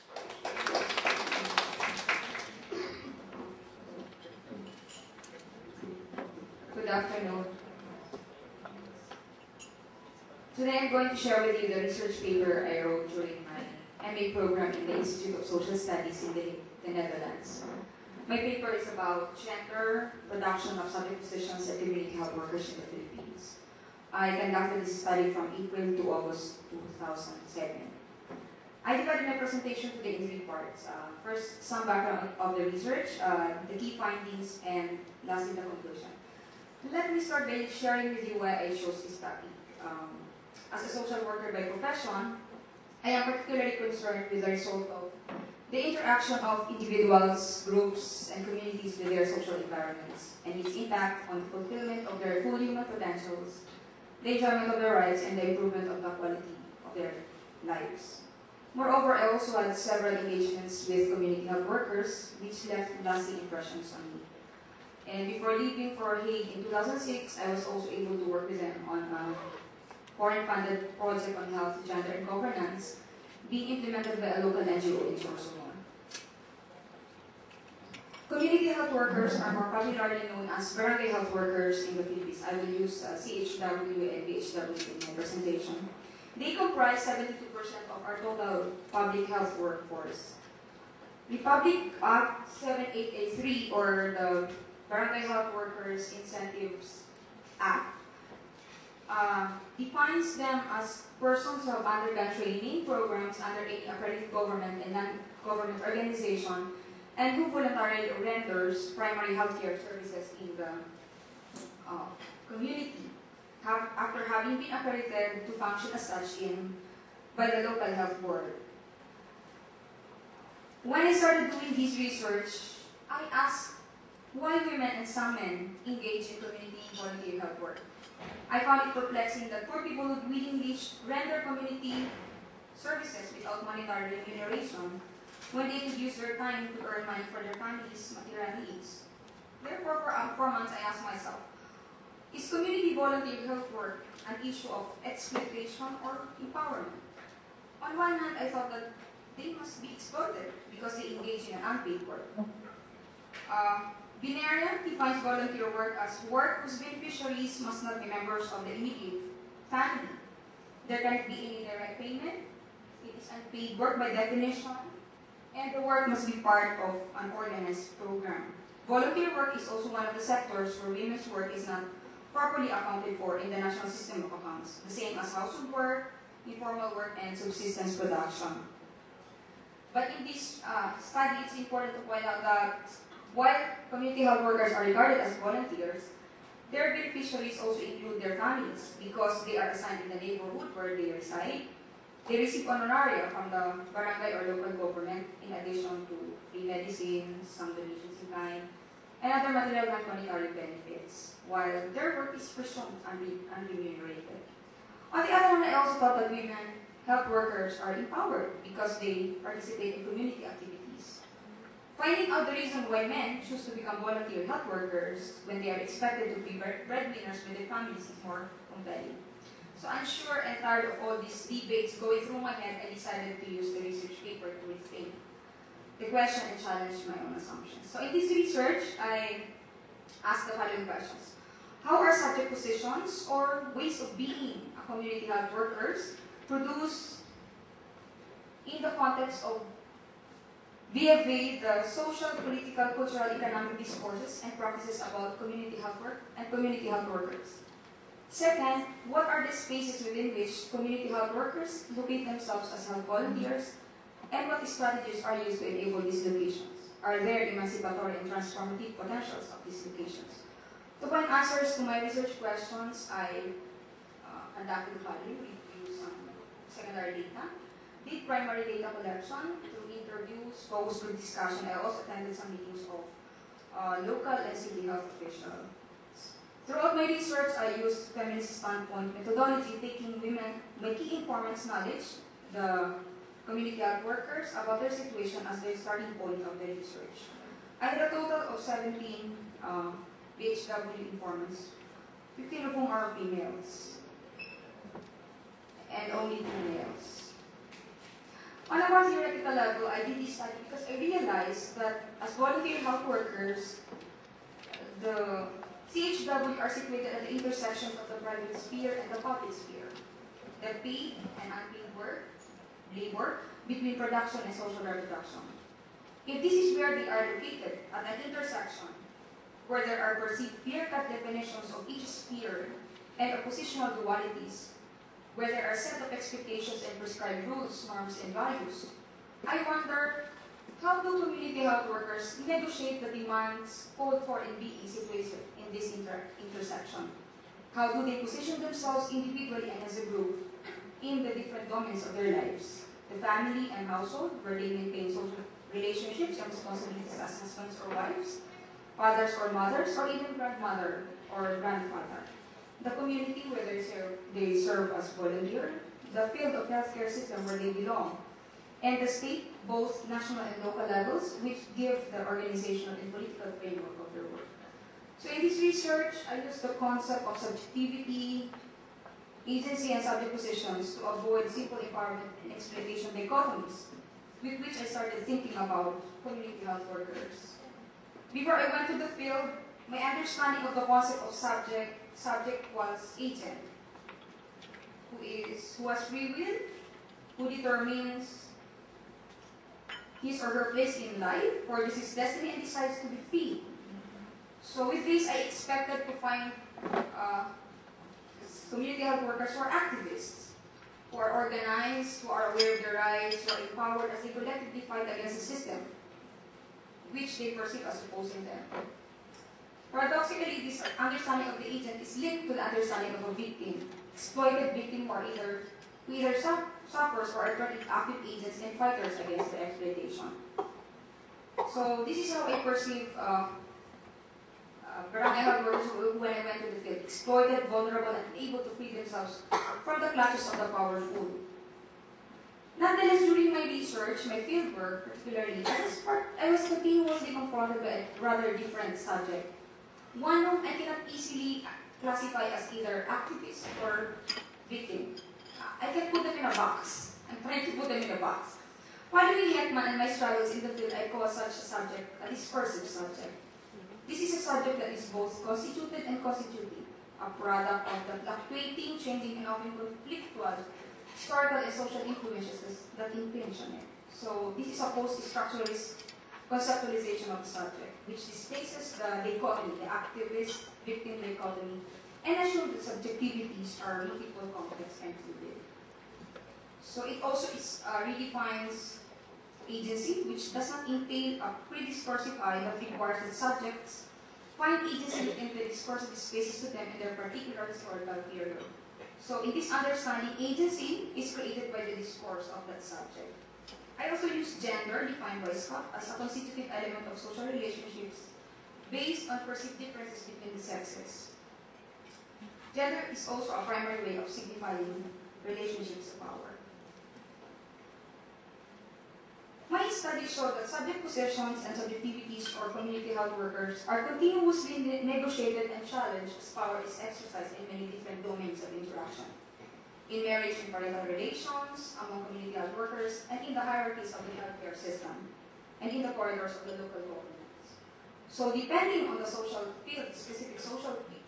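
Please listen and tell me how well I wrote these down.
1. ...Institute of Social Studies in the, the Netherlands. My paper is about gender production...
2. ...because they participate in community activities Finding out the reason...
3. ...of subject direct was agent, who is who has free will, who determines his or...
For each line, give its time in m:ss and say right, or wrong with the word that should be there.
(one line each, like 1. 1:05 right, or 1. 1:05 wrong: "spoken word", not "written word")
1. 0:14 right
2. 3:28 right
3. 6:21 wrong: "subject", not "direct".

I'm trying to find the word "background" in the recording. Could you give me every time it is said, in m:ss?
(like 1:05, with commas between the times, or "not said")
0:31.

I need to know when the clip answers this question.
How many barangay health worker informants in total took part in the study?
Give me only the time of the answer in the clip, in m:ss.
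4:48.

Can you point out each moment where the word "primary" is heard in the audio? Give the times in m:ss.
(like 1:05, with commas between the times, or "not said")
1:48, 4:28, 8:23.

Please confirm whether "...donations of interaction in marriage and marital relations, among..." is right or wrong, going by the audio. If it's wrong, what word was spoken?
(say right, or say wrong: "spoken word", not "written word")
wrong: "domains", not "donations".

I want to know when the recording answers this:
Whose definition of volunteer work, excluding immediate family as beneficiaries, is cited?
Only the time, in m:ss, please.
2:34.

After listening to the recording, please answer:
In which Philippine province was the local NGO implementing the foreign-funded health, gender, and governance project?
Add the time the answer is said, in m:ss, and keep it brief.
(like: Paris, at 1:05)
Sorsogon, at 1:15.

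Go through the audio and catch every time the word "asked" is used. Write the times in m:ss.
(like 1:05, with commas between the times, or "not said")
2:03, 2:20, 3:50.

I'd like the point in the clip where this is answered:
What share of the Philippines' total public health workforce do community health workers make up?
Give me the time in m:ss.
1:27.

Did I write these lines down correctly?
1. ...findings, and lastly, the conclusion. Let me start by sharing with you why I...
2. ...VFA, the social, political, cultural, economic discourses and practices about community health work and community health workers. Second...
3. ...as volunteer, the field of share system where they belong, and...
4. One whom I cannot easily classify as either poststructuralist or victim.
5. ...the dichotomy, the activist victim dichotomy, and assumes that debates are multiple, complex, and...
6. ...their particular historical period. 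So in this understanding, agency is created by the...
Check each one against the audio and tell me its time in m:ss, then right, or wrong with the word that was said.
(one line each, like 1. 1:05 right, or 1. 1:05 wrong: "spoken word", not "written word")
1. 0:33 right
2. 4:00 right
3. 5:54 wrong: "healthcare", not "share"
4. 7:20 wrong: "activist", not "poststructuralist"
5. 7:48 wrong: "subjectivities", not "debates"
6. 8:07 right.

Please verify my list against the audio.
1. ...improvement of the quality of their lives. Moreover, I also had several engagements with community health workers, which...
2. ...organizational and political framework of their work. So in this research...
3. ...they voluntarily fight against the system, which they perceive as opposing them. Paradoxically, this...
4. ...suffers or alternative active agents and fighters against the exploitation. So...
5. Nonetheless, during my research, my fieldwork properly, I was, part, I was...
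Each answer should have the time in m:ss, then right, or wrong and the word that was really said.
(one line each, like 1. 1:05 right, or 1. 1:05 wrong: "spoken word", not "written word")
1. 0:55 right
2. 6:02 right
3. 6:44 wrong: "collectively", not "voluntarily"
4. 6:56 right
5. 7:12 wrong: "particularly", not "properly".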